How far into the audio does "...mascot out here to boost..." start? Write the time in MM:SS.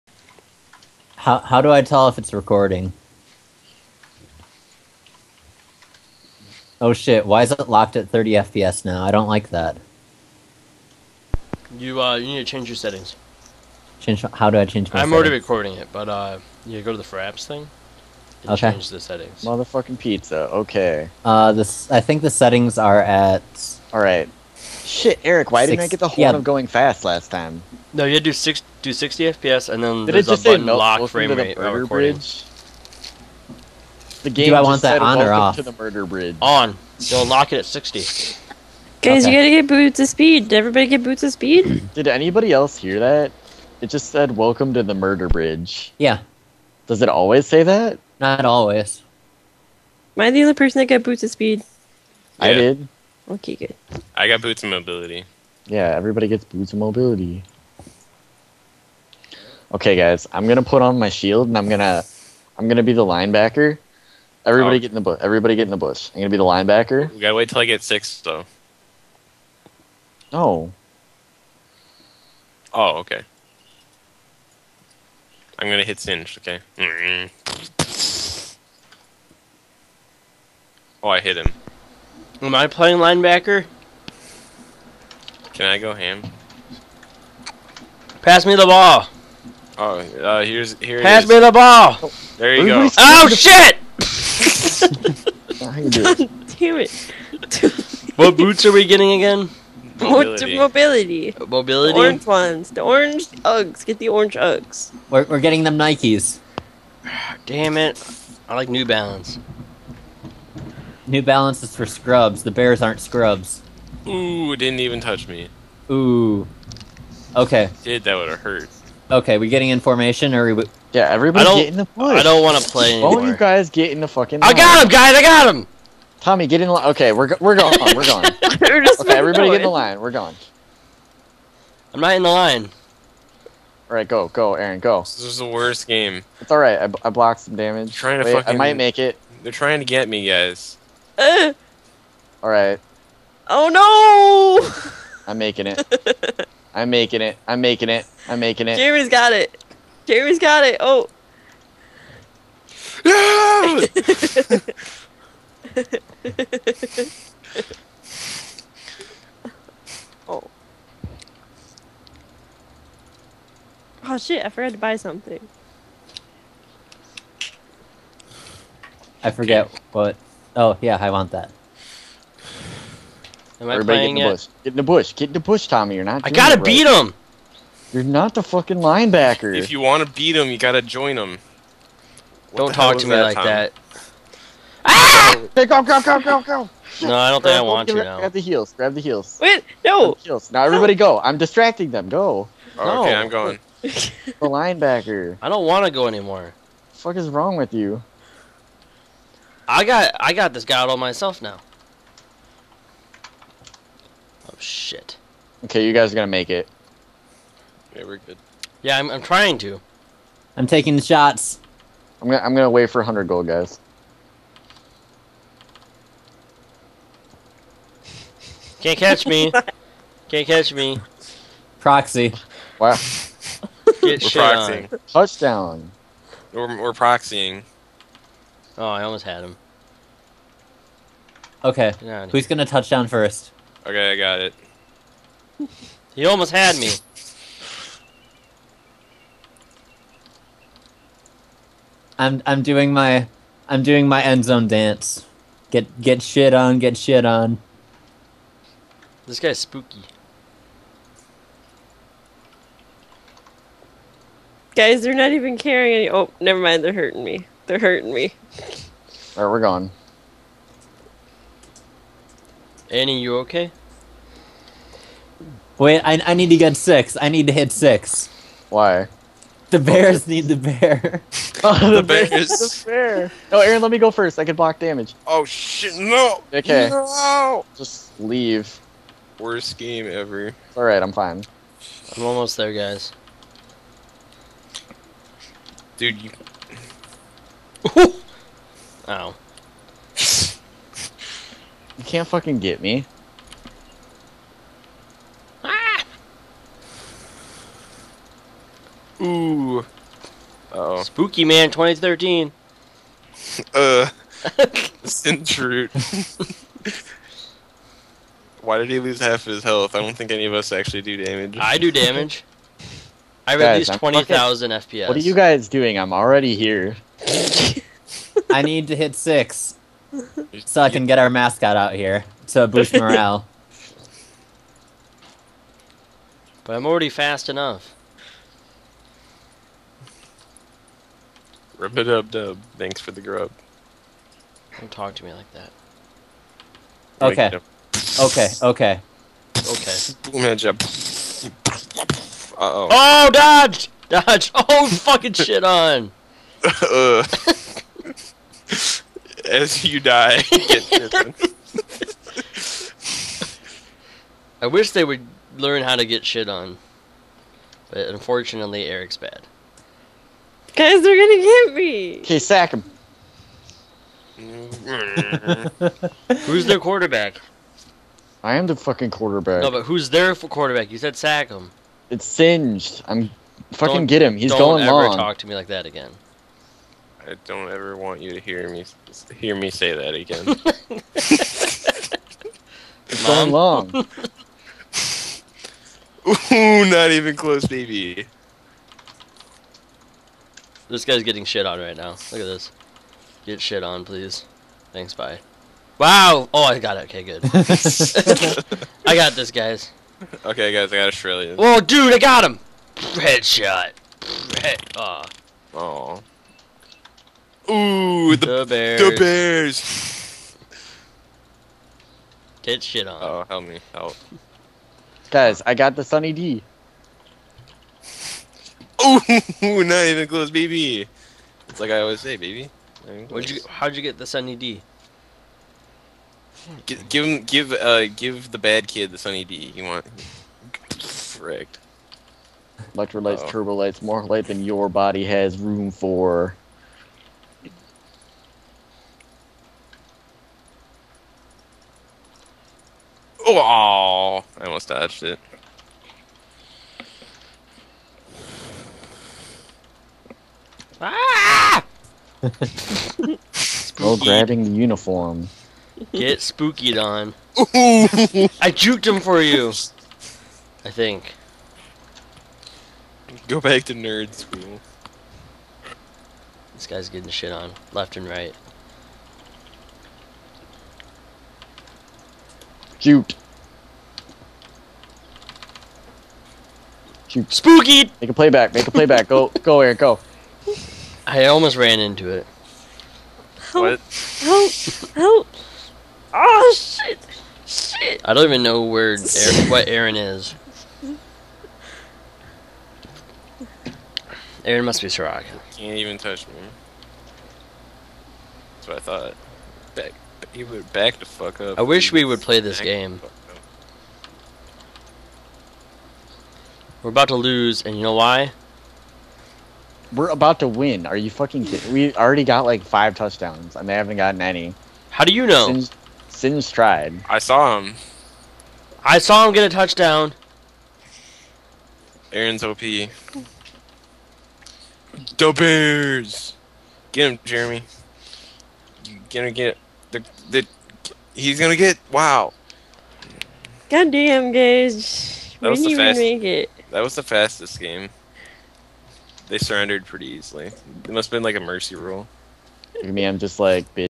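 05:21.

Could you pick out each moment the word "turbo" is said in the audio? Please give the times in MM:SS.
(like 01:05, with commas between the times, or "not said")
07:13.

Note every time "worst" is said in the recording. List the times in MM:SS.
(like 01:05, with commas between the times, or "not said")
02:15, 04:39.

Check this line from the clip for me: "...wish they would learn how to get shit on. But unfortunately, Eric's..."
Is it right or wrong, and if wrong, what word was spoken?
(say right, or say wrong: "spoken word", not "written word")
right.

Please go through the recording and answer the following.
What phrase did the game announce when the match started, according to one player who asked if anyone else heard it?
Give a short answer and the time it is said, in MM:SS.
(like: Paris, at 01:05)
Welcome to the murder bridge, at 00:44.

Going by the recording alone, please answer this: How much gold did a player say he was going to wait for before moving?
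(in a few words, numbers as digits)
100.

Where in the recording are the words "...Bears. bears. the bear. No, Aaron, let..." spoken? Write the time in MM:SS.
04:32.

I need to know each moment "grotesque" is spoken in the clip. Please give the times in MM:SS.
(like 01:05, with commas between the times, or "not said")
not said.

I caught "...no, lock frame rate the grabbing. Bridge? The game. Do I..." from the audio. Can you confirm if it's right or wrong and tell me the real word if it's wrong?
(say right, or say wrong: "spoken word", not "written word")
wrong: "recording", not "grabbing".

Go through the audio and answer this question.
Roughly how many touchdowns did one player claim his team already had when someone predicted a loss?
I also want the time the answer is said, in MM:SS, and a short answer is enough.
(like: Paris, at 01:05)
5, at 08:32.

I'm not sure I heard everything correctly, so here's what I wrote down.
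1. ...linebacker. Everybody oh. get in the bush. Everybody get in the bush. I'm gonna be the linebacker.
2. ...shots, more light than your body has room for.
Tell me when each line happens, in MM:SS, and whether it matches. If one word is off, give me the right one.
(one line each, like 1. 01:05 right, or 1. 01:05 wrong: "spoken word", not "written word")
1. 01:03 right
2. 07:13 wrong: "lights", not "shots".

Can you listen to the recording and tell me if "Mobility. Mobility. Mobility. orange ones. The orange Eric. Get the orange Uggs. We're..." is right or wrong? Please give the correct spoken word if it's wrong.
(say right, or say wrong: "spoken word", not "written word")
wrong: "Uggs", not "Eric".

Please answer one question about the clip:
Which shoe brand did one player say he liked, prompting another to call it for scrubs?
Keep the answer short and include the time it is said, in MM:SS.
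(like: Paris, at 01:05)
New Balance, at 01:48.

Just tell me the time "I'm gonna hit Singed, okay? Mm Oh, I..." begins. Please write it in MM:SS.
01:15.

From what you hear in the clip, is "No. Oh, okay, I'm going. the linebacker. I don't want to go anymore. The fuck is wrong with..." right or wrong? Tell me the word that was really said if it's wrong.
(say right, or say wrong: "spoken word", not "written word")
right.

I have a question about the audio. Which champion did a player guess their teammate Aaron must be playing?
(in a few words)
Soraka.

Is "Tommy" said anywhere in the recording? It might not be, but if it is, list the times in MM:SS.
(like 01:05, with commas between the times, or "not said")
02:06, 02:55.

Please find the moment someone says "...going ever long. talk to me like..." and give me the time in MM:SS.
06:14.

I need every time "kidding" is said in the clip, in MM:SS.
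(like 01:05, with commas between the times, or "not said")
08:31.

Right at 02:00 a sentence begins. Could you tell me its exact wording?
Yeah, everybody I don't, get in the I don't want to play anymore.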